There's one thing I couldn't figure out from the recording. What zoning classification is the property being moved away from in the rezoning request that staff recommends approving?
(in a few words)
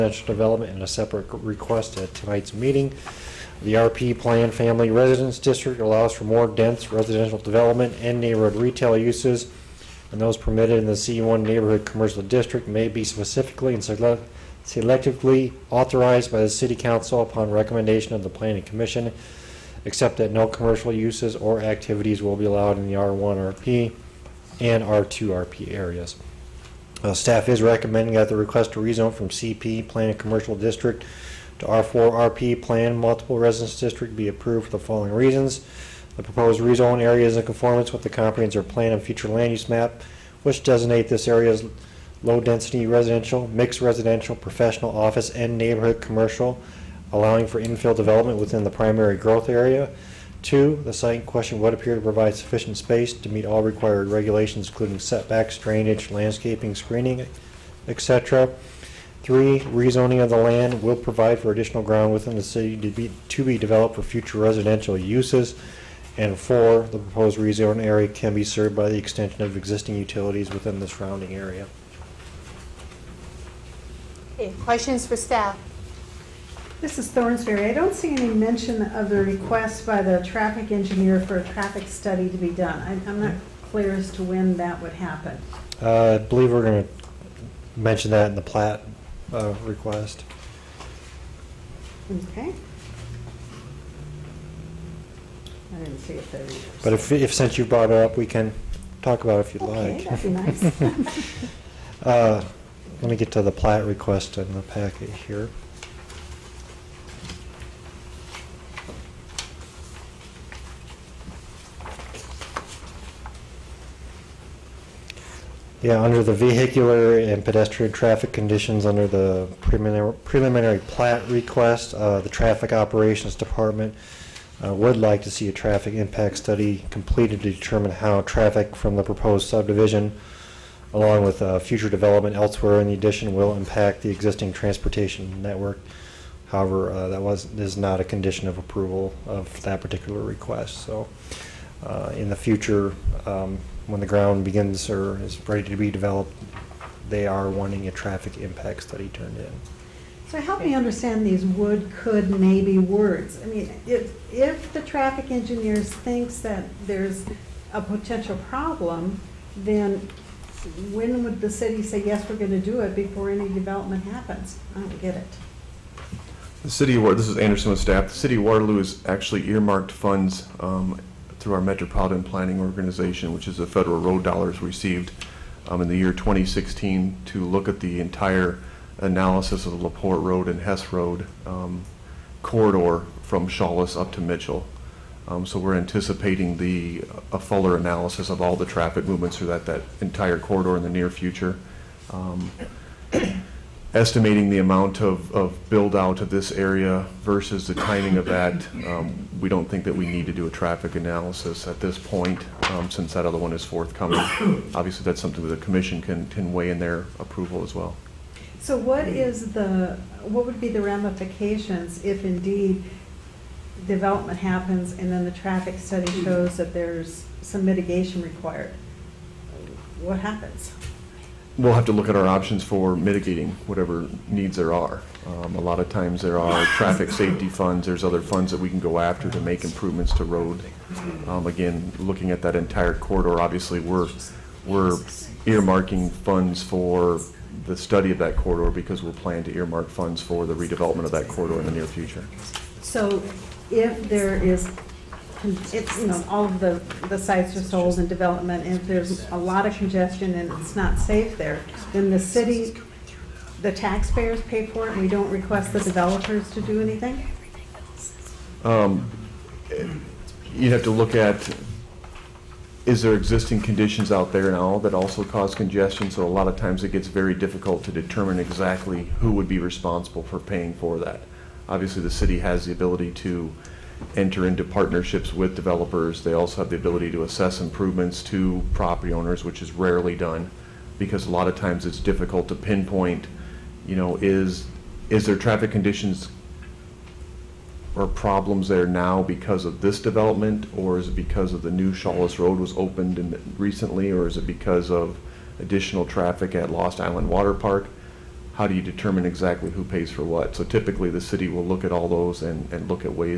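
CP, Planned Commercial.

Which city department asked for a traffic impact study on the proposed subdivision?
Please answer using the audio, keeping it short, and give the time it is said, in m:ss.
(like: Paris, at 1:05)
Traffic Operations Department, at 2:02.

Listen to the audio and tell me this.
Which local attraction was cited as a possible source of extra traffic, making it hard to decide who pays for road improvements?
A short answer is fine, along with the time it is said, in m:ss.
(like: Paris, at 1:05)
Lost Island Water Park, at 4:56.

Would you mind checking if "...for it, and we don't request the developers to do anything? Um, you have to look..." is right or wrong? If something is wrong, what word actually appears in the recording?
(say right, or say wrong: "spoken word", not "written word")
right.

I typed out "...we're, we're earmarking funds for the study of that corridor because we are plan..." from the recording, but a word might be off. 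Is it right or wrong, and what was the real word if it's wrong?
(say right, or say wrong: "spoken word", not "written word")
right.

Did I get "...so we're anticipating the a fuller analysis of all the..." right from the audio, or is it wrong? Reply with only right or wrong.
right.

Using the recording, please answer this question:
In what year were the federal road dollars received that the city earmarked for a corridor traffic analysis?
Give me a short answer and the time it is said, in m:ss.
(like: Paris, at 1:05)
2016, at 2:56.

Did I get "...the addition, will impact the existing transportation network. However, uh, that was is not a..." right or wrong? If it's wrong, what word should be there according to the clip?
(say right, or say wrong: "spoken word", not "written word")
right.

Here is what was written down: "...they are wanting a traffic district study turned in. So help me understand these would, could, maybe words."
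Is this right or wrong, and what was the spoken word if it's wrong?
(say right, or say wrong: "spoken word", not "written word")
wrong: "impact", not "district".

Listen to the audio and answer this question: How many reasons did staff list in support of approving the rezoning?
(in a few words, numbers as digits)
4.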